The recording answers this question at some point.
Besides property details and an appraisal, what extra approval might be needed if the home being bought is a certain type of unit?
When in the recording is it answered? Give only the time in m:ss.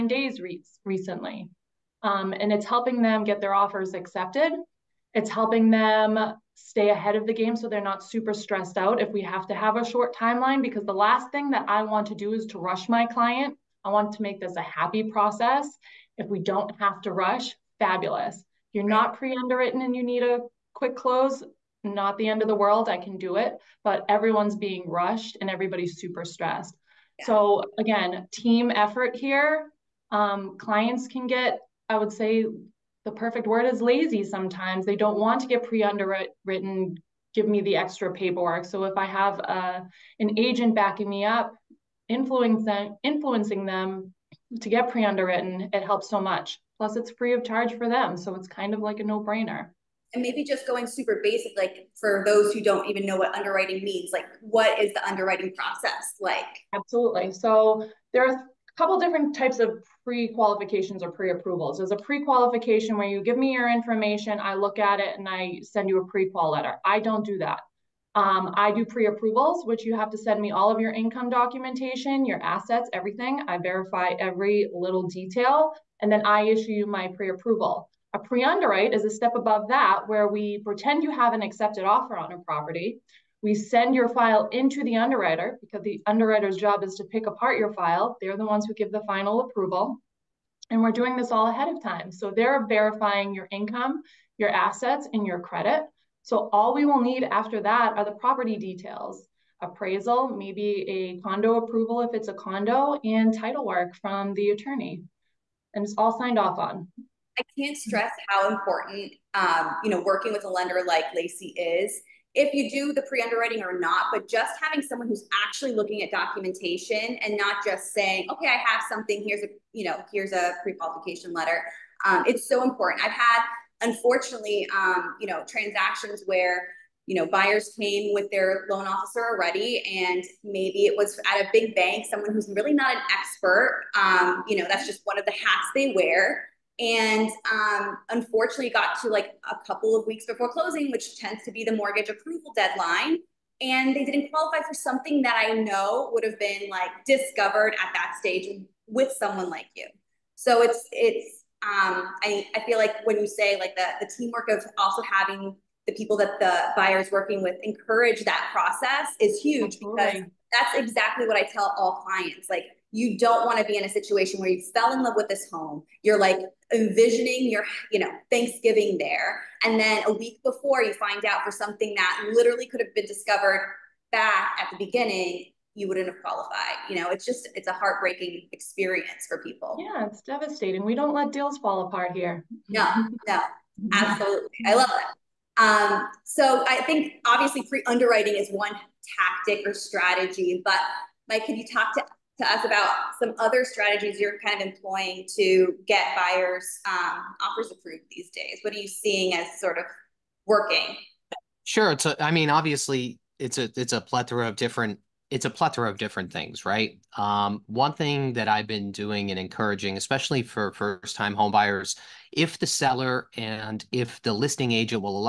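1:41.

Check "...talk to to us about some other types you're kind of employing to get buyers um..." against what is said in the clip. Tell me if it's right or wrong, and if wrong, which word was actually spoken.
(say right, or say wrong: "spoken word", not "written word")
wrong: "strategies", not "types".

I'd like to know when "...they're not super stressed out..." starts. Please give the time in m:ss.
0:07.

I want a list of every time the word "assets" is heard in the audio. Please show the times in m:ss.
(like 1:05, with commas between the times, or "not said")
1:12, 1:34.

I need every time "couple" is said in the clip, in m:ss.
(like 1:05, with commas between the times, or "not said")
0:58, 2:19.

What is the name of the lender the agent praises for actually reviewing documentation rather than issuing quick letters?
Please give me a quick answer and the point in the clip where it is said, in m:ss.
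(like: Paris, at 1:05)
Lacey, at 1:51.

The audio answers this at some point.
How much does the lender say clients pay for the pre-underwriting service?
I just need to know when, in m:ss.
0:47.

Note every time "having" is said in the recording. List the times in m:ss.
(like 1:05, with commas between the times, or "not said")
1:54, 2:35.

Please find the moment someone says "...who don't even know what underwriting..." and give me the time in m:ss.
0:52.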